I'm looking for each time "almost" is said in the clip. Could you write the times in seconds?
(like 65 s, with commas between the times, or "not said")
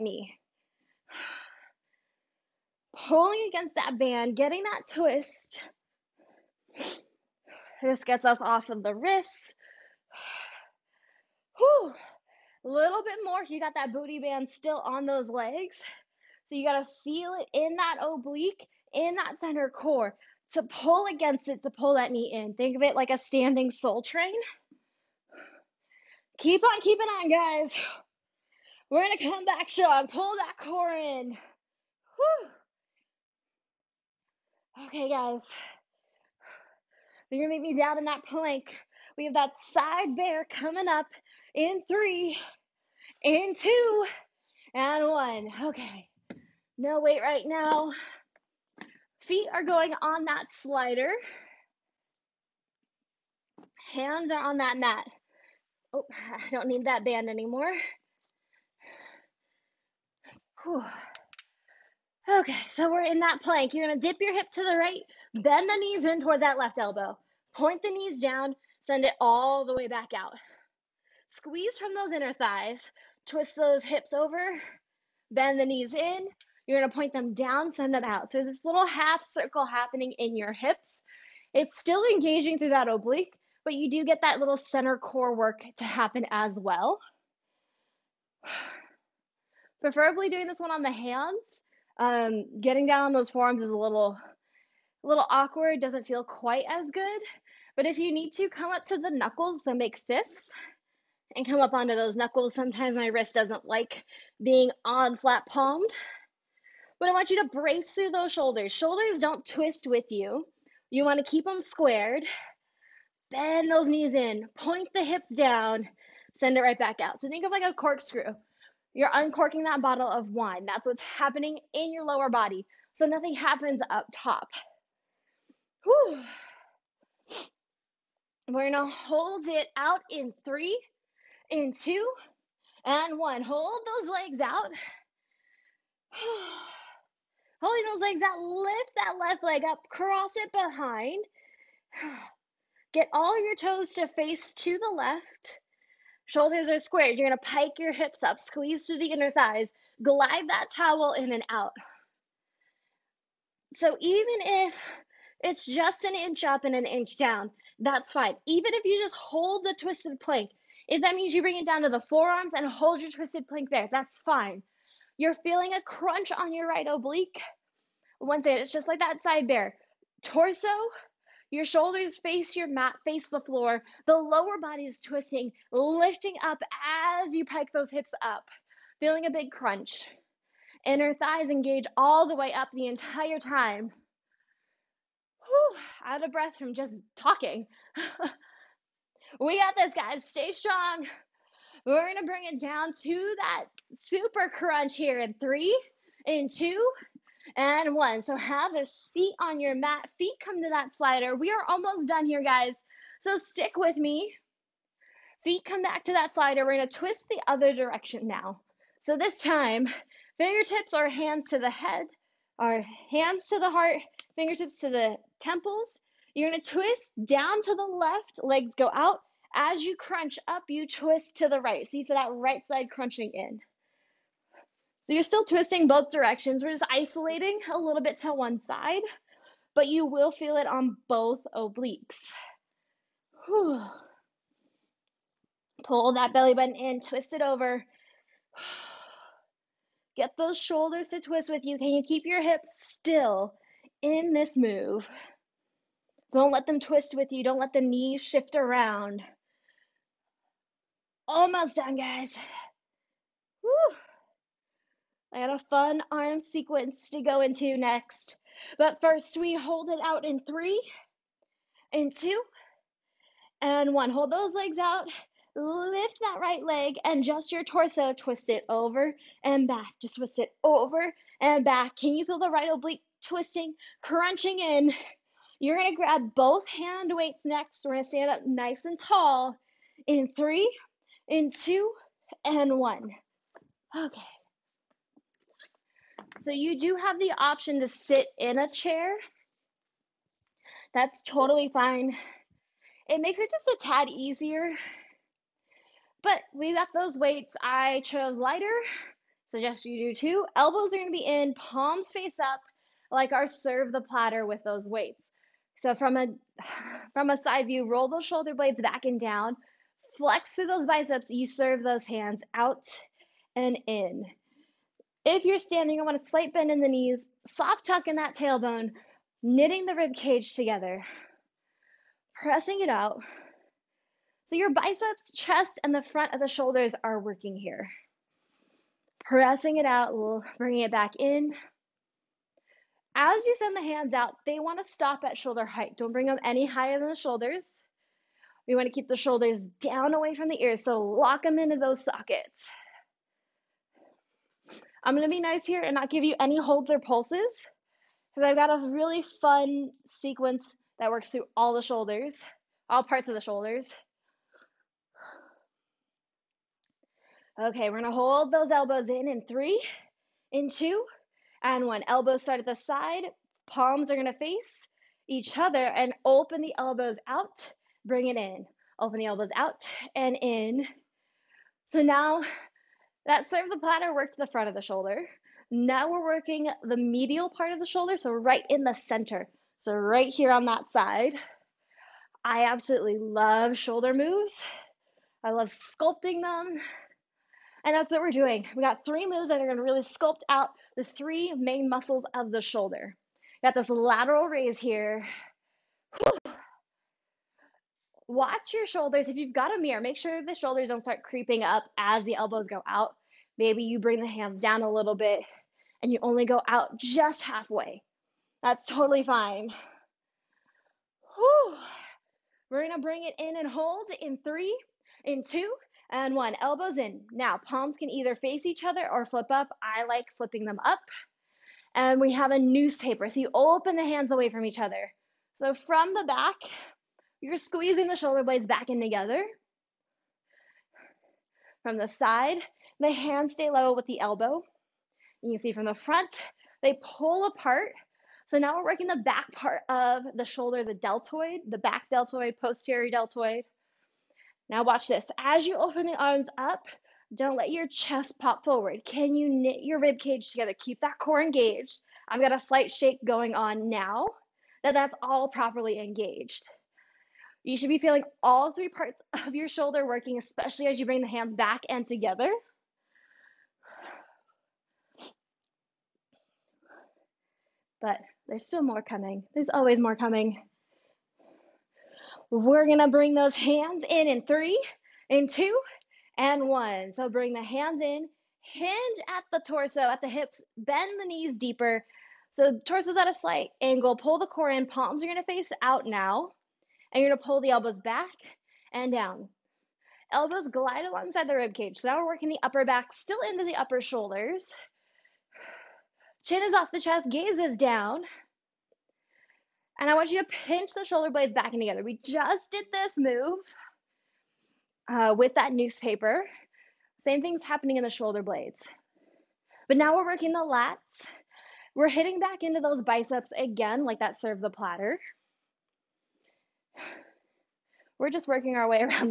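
201 s, 251 s.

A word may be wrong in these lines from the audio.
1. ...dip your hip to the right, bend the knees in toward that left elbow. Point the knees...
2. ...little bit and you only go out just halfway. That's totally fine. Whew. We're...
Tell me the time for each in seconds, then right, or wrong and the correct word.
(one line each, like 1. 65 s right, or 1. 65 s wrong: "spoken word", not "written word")
1. 63 s right
2. 404 s right.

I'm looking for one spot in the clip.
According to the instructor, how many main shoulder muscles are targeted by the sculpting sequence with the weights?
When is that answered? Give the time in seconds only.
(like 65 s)
391 s.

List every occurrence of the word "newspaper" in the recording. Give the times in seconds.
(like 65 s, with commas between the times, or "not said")
422 s, 505 s.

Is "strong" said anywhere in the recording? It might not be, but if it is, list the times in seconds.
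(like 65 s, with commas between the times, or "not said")
29 s, 190 s.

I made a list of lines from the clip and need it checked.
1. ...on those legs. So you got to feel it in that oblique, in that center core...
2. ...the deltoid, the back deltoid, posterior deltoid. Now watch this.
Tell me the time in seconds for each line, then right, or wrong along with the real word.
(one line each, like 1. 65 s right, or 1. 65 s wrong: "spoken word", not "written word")
1. 14 s right
2. 440 s right.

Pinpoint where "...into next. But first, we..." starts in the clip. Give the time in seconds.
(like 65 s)
257 s.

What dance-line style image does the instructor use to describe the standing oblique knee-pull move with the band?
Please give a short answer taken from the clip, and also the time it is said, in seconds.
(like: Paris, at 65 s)
standing soul train, at 23 s.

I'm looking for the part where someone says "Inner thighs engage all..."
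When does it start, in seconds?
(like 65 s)
180 s.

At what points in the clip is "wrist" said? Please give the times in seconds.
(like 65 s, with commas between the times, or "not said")
8 s, 103 s.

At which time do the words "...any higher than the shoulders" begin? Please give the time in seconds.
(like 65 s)
336 s.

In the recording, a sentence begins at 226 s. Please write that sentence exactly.
We're just isolating a little bit to one side, but you will feel it on both obliques.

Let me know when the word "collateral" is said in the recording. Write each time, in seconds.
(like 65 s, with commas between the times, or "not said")
not said.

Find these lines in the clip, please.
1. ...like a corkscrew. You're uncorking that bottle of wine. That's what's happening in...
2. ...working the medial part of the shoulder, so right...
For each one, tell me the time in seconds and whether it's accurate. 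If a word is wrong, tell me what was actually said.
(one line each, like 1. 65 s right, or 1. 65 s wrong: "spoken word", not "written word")
1. 117 s right
2. 376 s right.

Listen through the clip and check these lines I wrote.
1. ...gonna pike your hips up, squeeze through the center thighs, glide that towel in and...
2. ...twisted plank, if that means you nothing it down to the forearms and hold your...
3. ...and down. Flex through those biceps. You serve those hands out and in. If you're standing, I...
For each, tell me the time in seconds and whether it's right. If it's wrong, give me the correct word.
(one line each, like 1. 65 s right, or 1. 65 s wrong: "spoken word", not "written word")
1. 147 s wrong: "inner", not "center"
2. 159 s wrong: "bring", not "nothing"
3. 309 s right.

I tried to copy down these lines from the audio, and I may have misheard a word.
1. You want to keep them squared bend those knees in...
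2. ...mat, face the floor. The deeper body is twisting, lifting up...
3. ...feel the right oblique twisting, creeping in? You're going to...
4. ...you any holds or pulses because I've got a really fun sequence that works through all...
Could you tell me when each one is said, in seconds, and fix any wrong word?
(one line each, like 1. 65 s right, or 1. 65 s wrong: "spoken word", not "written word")
1. 110 s right
2. 172 s wrong: "lower", not "deeper"
3. 272 s wrong: "crunching", not "creeping"
4. 346 s right.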